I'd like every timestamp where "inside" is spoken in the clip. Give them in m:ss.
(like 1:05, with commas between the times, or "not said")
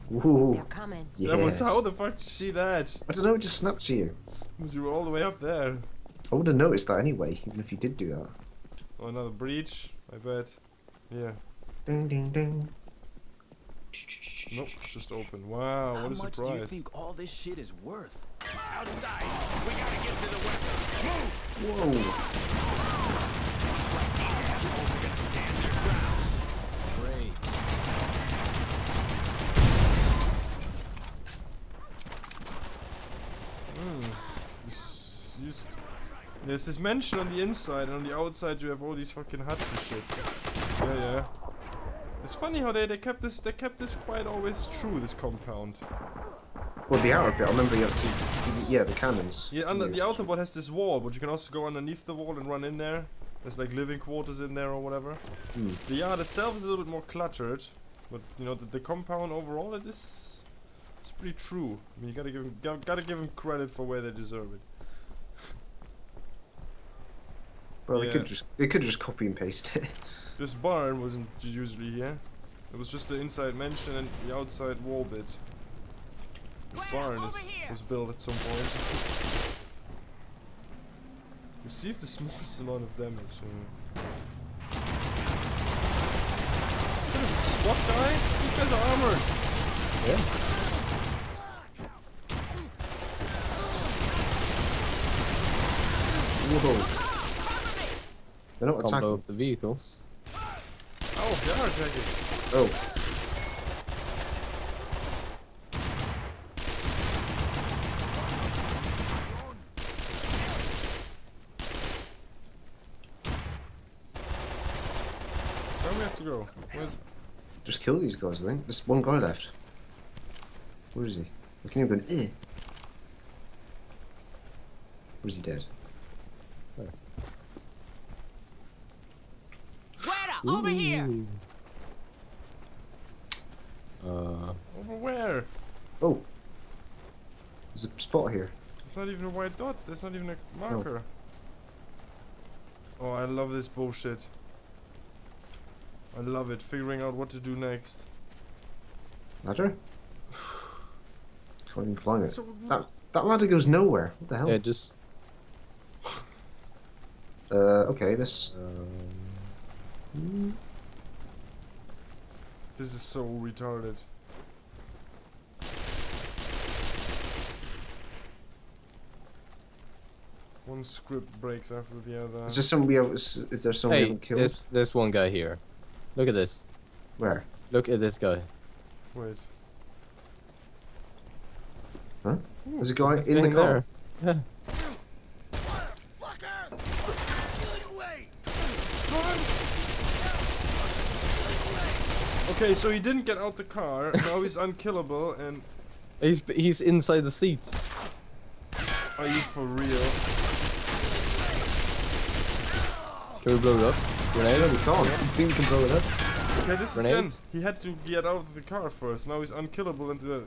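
0:37, 1:13, 3:16.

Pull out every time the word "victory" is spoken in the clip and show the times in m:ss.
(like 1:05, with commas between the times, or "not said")
not said.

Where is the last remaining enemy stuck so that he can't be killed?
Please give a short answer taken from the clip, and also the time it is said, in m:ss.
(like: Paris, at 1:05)
in the car, at 3:02.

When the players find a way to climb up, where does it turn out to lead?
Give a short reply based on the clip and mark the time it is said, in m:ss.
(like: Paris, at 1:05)
nowhere, at 2:33.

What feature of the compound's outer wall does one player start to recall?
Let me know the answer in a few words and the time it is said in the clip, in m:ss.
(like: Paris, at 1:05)
the cannons, at 0:48.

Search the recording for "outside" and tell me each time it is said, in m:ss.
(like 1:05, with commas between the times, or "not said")
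0:18, 0:38, 1:14.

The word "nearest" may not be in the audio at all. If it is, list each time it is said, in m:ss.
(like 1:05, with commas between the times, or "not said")
not said.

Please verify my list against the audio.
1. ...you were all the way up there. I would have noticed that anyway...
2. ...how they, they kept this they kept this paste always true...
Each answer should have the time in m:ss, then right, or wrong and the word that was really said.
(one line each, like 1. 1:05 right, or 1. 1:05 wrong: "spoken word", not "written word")
1. 0:04 right
2. 0:42 wrong: "quite", not "paste".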